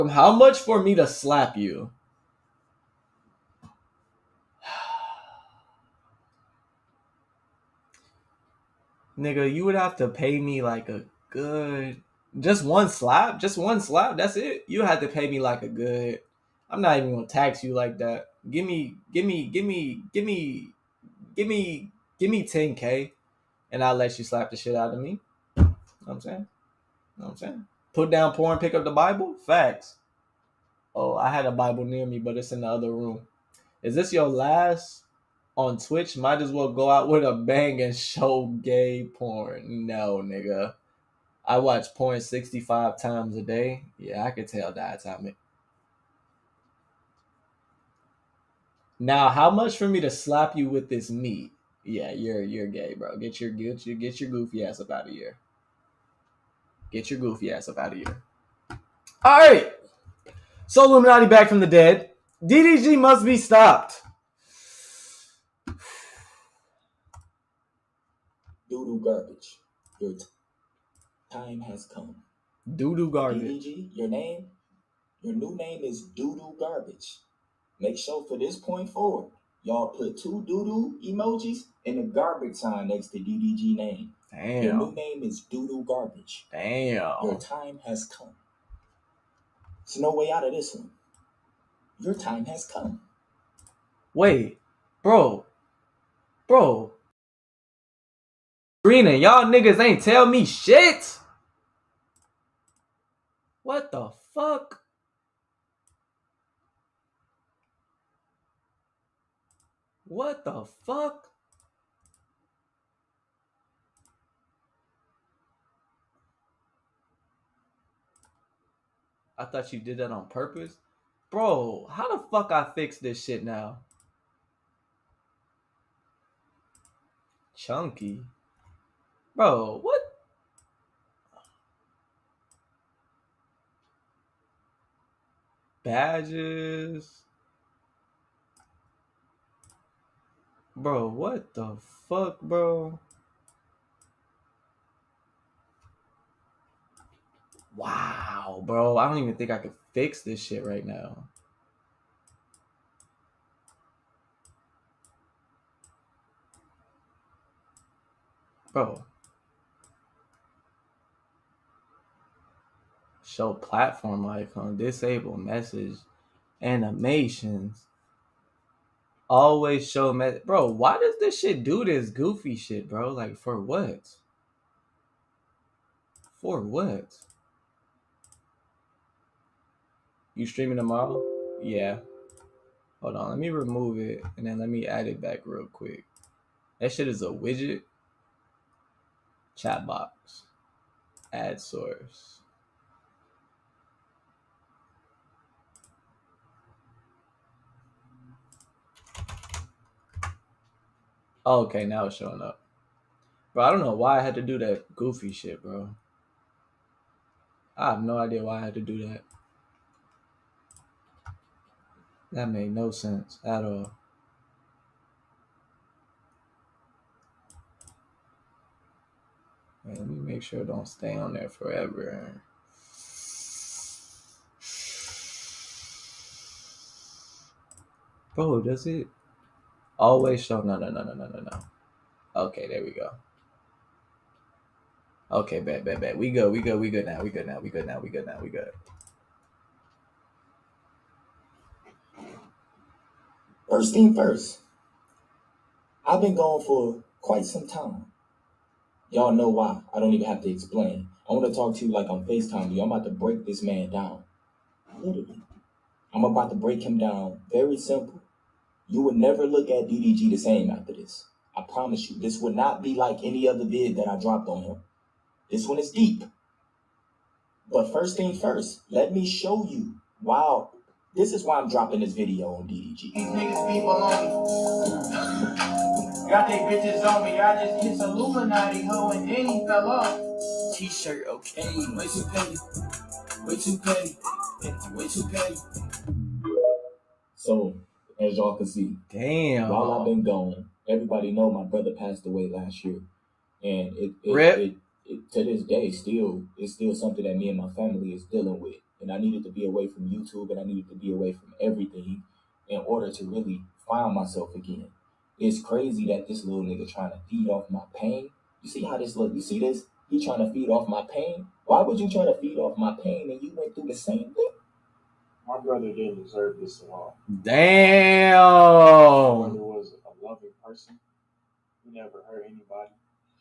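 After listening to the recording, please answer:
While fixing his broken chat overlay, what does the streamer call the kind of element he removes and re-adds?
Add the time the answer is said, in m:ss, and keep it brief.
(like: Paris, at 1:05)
widget, at 3:07.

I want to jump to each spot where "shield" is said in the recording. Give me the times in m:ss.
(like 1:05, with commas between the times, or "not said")
not said.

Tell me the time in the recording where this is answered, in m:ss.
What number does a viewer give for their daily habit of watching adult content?
0:42.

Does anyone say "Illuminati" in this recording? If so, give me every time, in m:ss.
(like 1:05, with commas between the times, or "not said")
1:00, 4:37.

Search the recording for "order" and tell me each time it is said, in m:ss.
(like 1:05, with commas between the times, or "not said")
5:02.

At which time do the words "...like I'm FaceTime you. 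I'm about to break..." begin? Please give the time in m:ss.
4:11.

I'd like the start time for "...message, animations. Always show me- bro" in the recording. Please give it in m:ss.
2:45.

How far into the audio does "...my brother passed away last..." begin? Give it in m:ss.
4:51.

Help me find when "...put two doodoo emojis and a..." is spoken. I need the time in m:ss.
1:19.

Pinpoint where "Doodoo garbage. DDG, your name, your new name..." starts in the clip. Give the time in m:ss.
1:12.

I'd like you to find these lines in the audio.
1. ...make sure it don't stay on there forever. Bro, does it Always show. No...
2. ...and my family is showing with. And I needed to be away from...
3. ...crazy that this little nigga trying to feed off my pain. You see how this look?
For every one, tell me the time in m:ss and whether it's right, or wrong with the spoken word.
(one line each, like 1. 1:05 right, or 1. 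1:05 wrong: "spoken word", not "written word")
1. 3:40 right
2. 4:57 wrong: "dealing", not "showing"
3. 5:05 right.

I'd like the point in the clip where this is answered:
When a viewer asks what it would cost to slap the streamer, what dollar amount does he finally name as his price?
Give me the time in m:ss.
0:22.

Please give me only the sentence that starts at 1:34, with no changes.
Wait, bro, bro, Green and y'all niggas ain't tell me shit.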